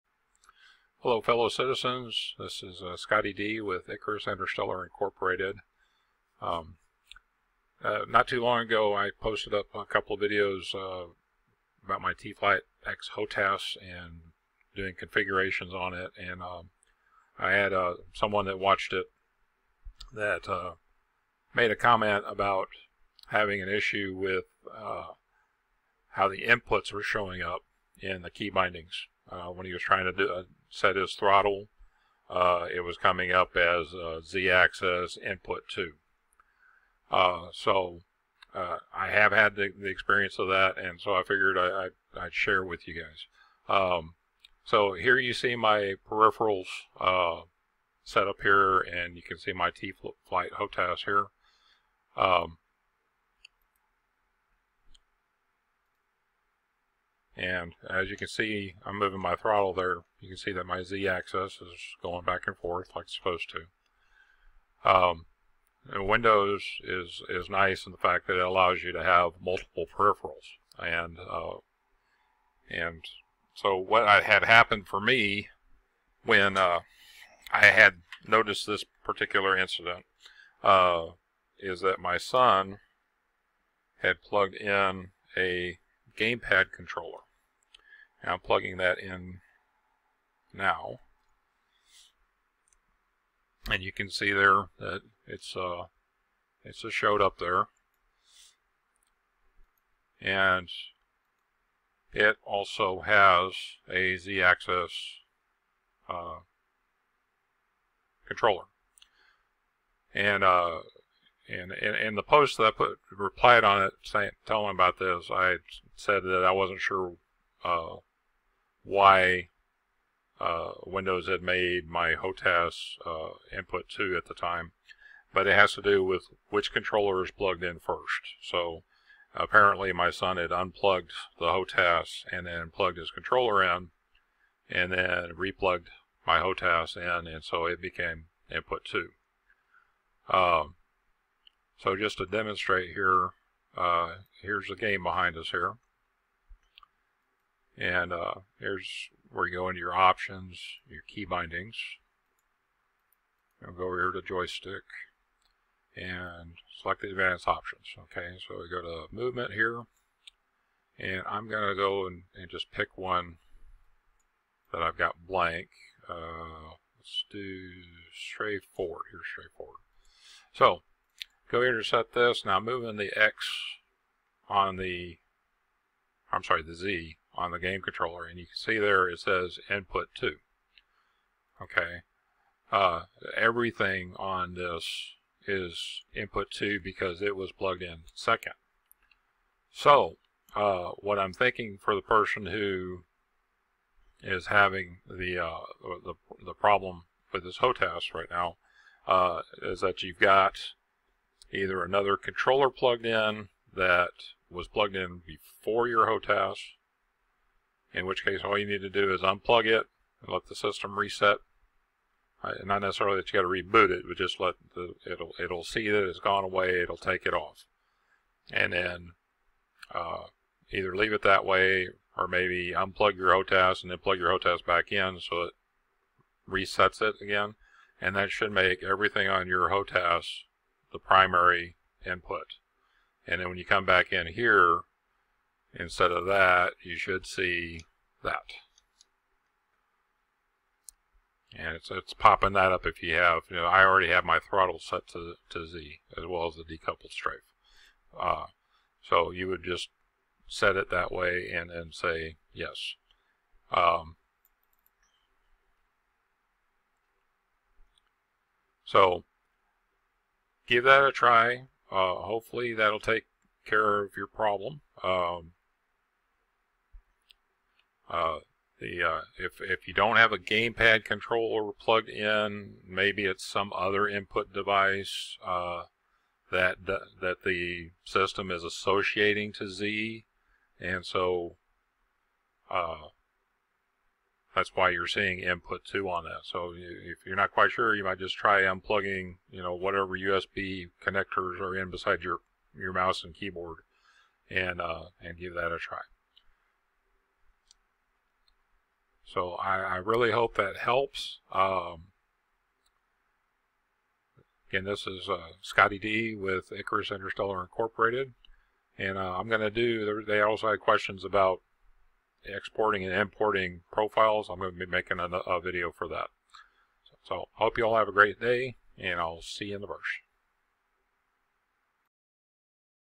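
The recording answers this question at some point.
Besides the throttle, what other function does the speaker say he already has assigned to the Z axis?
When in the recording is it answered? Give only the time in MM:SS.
04:06.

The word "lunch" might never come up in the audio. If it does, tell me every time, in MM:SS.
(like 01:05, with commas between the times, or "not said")
not said.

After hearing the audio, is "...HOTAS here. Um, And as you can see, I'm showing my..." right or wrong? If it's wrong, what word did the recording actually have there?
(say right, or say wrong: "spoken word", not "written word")
wrong: "moving", not "showing".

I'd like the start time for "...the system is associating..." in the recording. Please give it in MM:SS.
04:37.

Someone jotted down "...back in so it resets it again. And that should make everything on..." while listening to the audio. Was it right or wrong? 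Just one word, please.
right.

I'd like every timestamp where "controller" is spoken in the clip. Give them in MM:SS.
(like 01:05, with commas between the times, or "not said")
01:26, 01:48, 02:06, 02:13, 02:57, 03:22, 04:31.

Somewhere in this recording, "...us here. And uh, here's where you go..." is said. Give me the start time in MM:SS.
02:25.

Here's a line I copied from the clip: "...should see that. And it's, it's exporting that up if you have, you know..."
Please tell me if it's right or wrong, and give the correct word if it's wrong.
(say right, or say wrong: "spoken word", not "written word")
wrong: "popping", not "exporting".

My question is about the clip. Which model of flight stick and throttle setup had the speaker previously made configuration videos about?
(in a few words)
T-Flight X HOTAS.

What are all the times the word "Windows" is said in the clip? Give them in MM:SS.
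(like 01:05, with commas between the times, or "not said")
01:05, 02:00.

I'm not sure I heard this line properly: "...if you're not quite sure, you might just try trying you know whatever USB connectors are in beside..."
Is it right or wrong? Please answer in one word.
wrong.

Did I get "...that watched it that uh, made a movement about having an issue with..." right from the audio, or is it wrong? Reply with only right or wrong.
wrong.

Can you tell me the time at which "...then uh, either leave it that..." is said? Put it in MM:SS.
03:38.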